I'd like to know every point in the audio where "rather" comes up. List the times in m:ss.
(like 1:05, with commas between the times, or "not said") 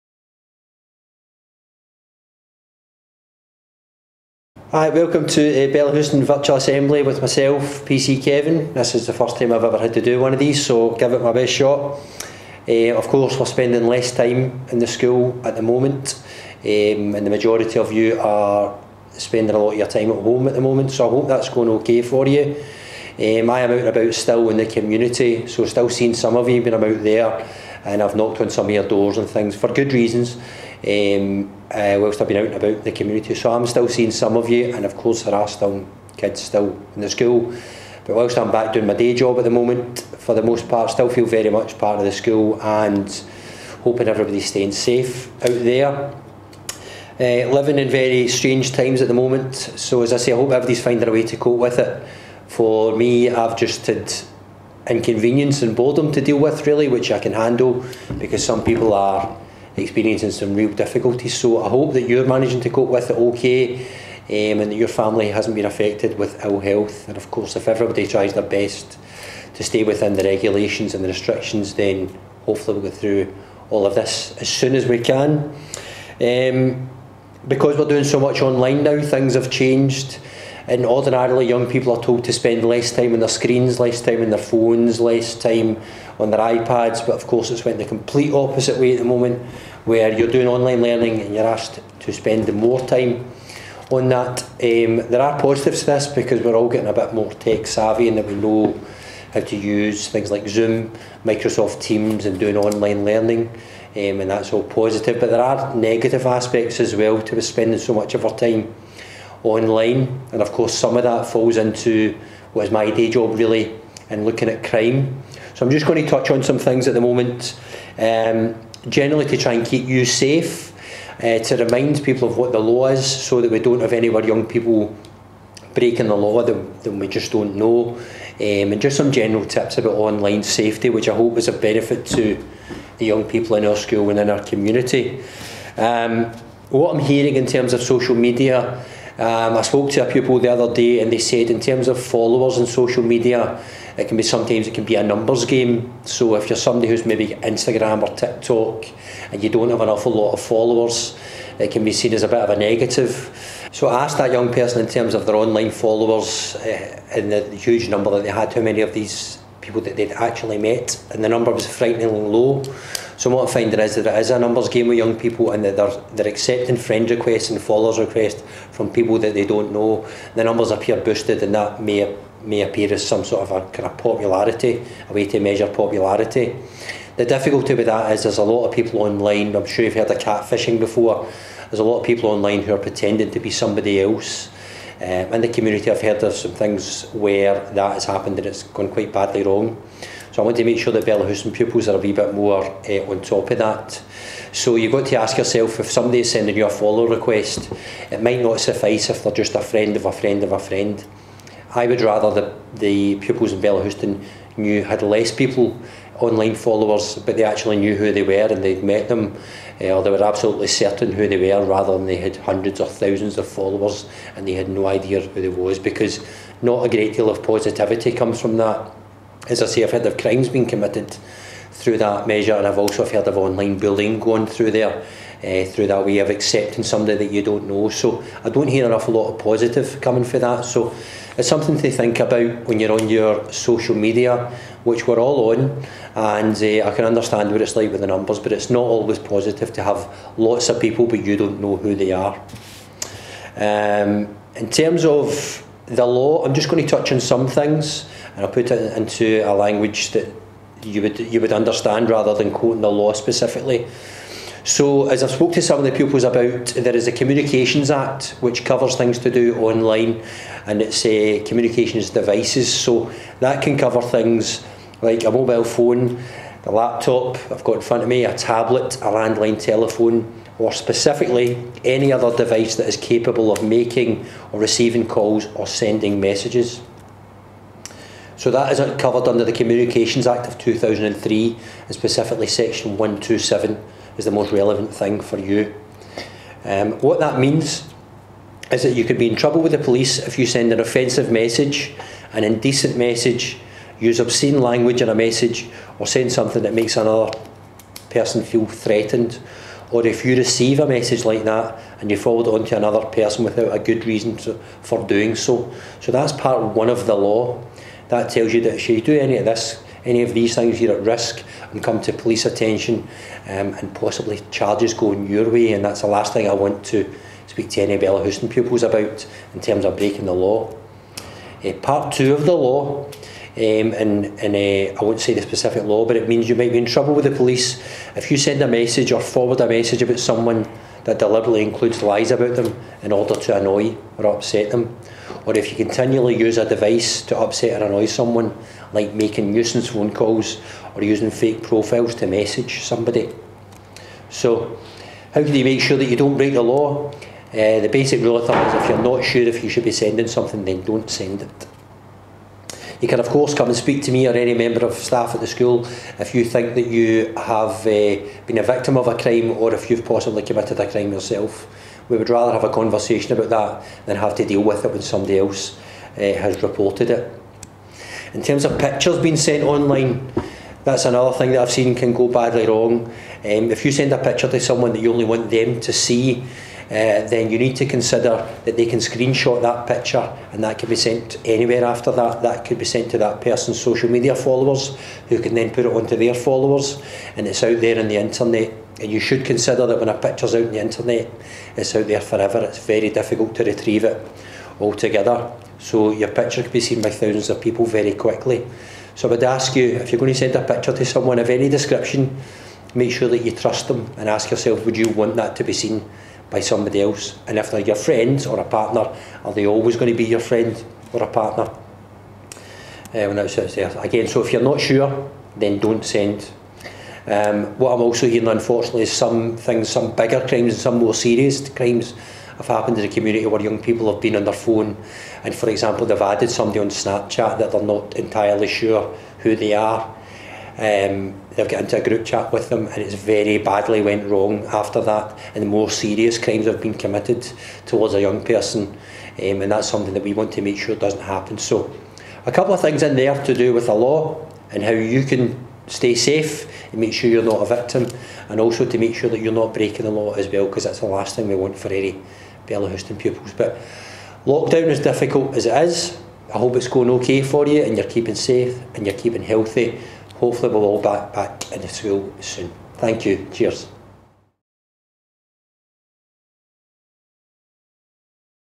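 3:22, 3:31, 4:12, 6:02.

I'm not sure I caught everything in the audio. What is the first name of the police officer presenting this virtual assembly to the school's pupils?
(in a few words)
Kevin.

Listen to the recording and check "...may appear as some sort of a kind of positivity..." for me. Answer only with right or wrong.
wrong.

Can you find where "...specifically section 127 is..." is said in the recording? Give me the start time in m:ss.
4:41.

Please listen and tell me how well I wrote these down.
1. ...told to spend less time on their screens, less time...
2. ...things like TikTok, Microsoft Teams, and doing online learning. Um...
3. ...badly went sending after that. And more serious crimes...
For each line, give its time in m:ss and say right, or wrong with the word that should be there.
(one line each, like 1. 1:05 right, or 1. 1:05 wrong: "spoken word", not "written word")
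1. 1:22 right
2. 1:40 wrong: "Zoom", not "TikTok"
3. 7:13 wrong: "wrong", not "sending".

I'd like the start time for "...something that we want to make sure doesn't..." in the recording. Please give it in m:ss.
7:19.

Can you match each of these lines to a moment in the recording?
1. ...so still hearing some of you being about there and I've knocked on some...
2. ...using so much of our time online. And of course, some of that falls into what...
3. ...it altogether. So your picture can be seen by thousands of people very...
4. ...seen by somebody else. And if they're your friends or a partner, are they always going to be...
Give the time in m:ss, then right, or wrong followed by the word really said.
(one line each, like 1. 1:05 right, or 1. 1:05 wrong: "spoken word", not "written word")
1. 0:25 wrong: "seeing", not "hearing"
2. 1:47 wrong: "spending", not "using"
3. 6:34 right
4. 6:45 right.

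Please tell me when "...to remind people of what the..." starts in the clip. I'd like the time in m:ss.
2:01.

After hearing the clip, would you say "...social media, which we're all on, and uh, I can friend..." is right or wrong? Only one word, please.
wrong.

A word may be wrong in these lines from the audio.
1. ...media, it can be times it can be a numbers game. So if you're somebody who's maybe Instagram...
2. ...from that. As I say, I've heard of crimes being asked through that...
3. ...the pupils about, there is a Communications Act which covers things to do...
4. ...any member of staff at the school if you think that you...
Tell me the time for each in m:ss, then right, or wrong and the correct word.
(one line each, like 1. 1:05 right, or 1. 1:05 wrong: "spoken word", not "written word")
1. 2:23 wrong: "sometimes", not "times"
2. 3:38 wrong: "committed", not "asked"
3. 4:15 right
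4. 5:54 right.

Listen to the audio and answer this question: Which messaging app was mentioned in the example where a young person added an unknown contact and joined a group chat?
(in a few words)
Snapchat.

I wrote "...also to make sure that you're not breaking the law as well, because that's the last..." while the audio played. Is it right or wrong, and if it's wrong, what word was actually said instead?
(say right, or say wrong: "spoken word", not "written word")
right.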